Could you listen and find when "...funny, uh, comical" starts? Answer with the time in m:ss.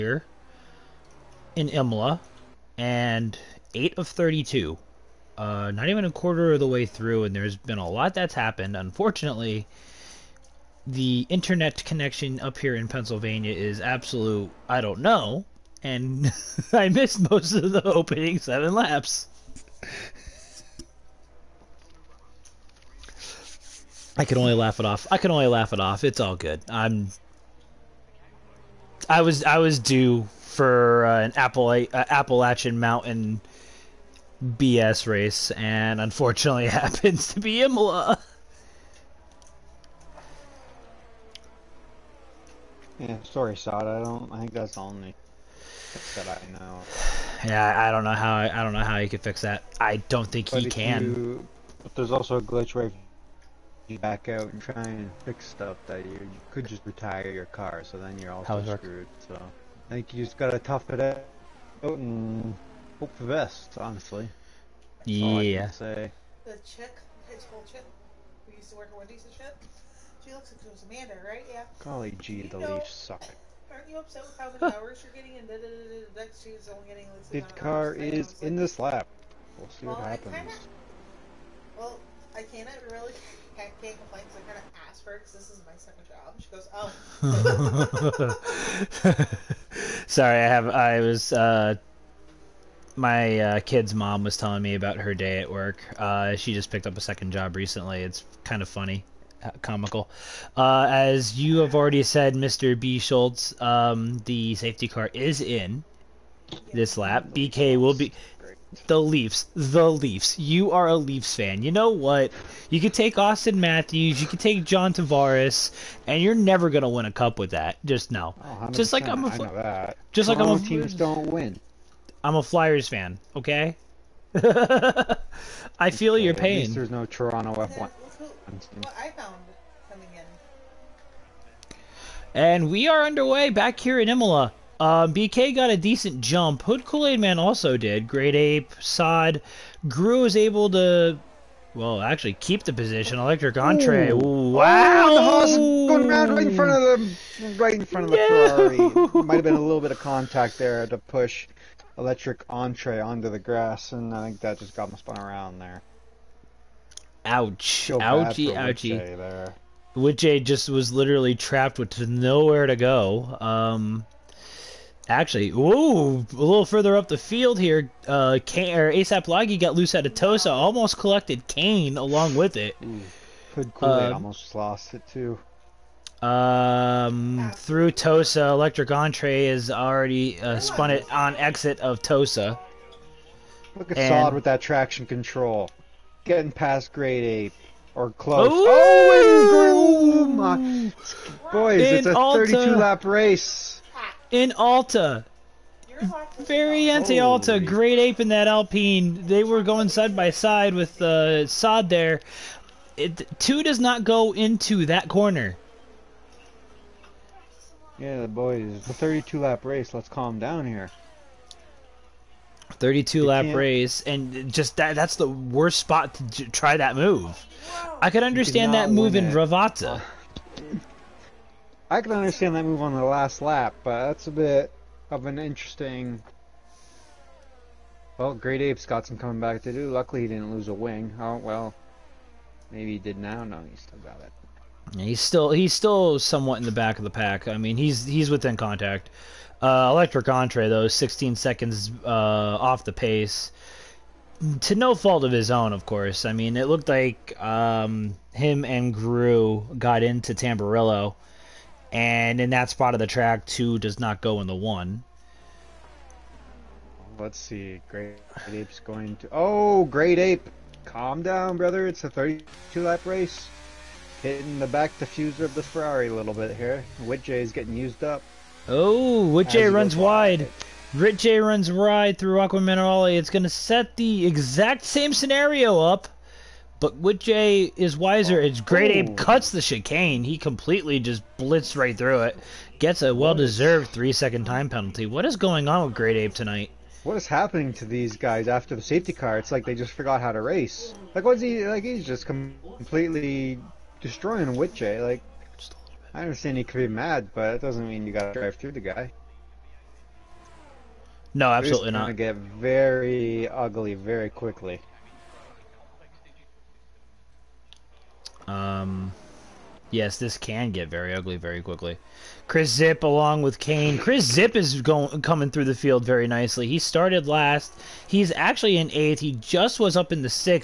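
1:38.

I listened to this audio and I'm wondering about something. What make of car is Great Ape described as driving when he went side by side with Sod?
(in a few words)
Alpine.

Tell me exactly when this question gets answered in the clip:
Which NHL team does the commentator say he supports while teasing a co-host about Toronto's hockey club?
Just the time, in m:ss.
2:02.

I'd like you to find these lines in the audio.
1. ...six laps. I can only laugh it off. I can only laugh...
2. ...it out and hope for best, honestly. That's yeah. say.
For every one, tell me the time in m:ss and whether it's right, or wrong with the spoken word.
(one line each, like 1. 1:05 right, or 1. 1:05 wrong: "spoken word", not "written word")
1. 0:18 wrong: "seven", not "six"
2. 1:00 right.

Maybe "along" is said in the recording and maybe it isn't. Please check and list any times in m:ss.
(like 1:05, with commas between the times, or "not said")
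2:51, 5:13.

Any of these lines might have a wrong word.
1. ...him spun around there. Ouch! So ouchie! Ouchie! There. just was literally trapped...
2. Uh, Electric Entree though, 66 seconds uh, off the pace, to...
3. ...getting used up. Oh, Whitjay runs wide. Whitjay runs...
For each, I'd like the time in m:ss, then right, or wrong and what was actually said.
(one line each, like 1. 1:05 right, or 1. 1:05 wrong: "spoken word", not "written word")
1. 2:34 right
2. 3:59 wrong: "16", not "66"
3. 4:27 right.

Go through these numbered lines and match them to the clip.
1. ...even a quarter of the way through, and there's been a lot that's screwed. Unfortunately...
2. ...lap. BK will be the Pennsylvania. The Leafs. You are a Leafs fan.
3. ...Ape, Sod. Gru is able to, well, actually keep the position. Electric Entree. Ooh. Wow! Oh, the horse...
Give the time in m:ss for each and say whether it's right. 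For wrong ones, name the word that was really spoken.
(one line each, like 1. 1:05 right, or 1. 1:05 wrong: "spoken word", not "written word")
1. 0:05 wrong: "happened", not "screwed"
2. 1:46 wrong: "Leafs", not "Pennsylvania"
3. 2:18 right.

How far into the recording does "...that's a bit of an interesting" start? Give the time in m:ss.
3:44.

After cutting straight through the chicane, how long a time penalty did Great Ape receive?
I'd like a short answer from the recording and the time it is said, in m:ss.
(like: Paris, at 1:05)
3 seconds, at 4:43.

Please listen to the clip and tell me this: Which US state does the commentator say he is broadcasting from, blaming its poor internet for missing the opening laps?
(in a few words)
Pennsylvania.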